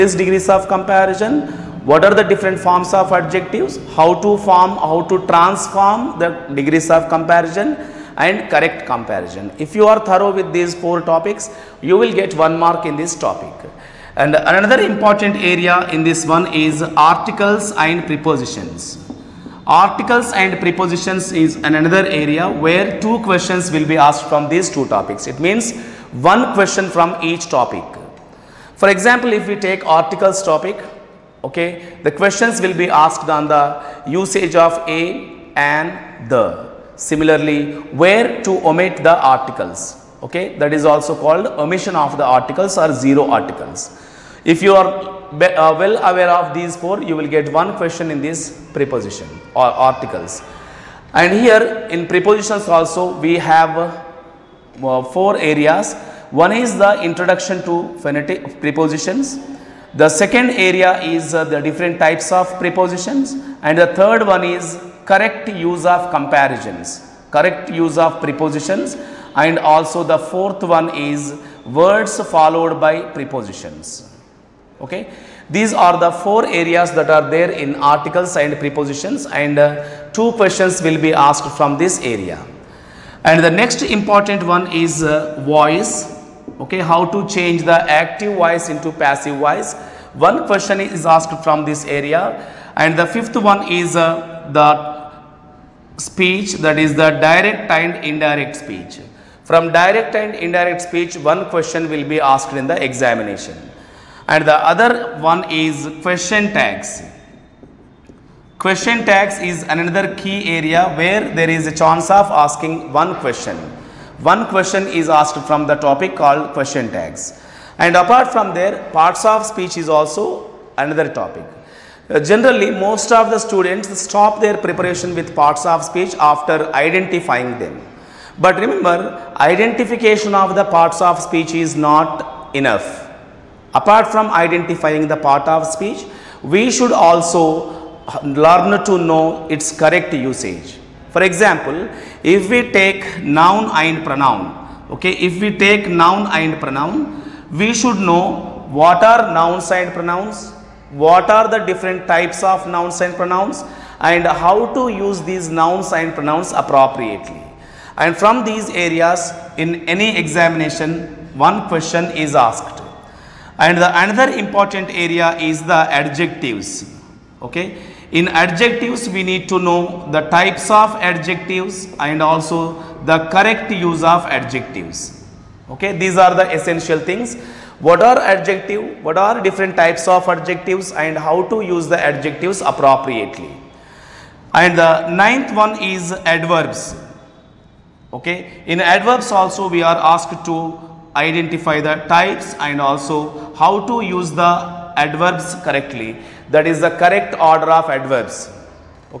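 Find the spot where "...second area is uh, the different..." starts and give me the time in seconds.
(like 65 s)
60 s.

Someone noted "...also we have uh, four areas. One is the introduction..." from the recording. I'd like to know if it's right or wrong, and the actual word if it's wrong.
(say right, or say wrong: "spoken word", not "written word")
right.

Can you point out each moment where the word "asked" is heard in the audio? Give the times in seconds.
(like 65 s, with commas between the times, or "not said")
23 s, 32 s, 81 s, 91 s, 102 s, 115 s, 162 s, 189 s.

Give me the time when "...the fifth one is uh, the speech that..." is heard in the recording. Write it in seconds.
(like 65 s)
92 s.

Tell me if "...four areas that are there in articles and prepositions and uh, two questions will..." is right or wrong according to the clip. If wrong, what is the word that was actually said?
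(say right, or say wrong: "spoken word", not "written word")
right.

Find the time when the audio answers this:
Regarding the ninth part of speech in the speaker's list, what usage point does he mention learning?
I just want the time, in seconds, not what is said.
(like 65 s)
197 s.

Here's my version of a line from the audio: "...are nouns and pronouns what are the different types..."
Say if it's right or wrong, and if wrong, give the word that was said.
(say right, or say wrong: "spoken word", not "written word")
right.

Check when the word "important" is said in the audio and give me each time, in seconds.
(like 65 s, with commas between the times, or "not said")
14 s, 83 s, 164 s.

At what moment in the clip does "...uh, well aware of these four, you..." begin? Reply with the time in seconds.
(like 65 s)
44 s.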